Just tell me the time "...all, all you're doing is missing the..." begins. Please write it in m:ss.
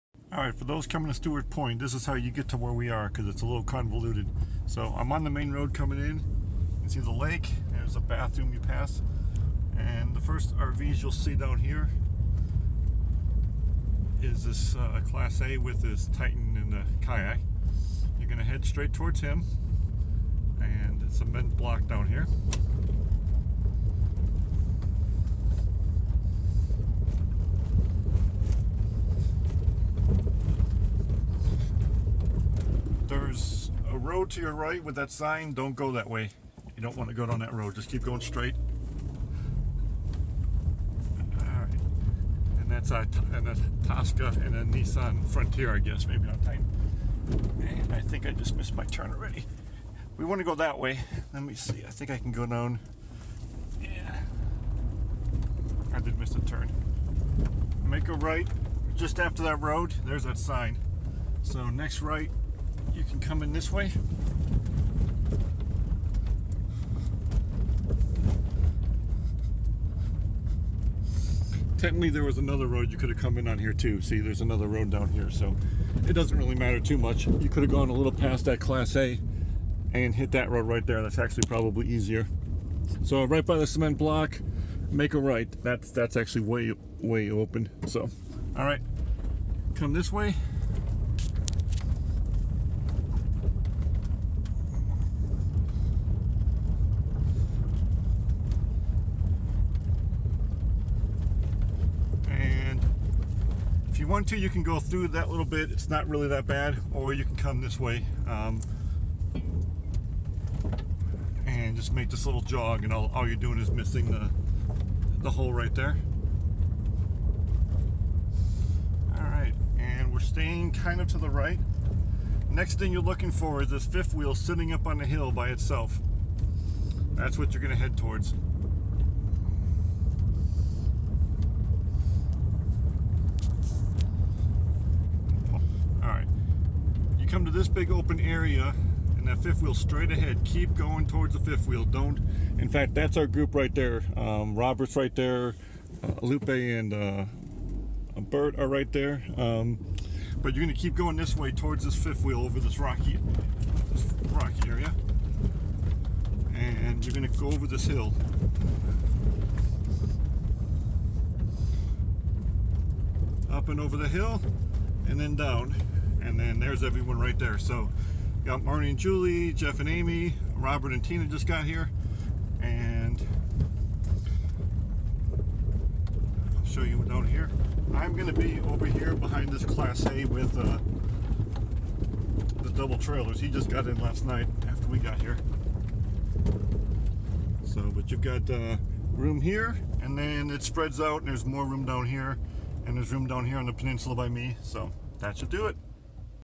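1:52.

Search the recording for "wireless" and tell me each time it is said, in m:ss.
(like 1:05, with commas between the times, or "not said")
not said.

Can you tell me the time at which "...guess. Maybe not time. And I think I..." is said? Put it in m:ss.
0:45.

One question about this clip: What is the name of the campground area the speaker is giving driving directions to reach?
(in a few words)
Stewart Point.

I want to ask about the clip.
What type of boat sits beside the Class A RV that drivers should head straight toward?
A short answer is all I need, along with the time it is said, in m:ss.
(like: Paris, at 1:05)
kayak, at 0:17.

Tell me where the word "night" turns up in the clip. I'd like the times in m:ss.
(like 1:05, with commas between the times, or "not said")
3:04.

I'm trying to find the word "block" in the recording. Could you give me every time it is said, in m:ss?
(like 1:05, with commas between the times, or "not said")
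0:21, 1:23.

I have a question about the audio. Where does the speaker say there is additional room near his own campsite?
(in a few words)
the peninsula.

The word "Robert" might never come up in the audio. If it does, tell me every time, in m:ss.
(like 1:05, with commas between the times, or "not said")
2:24, 2:50.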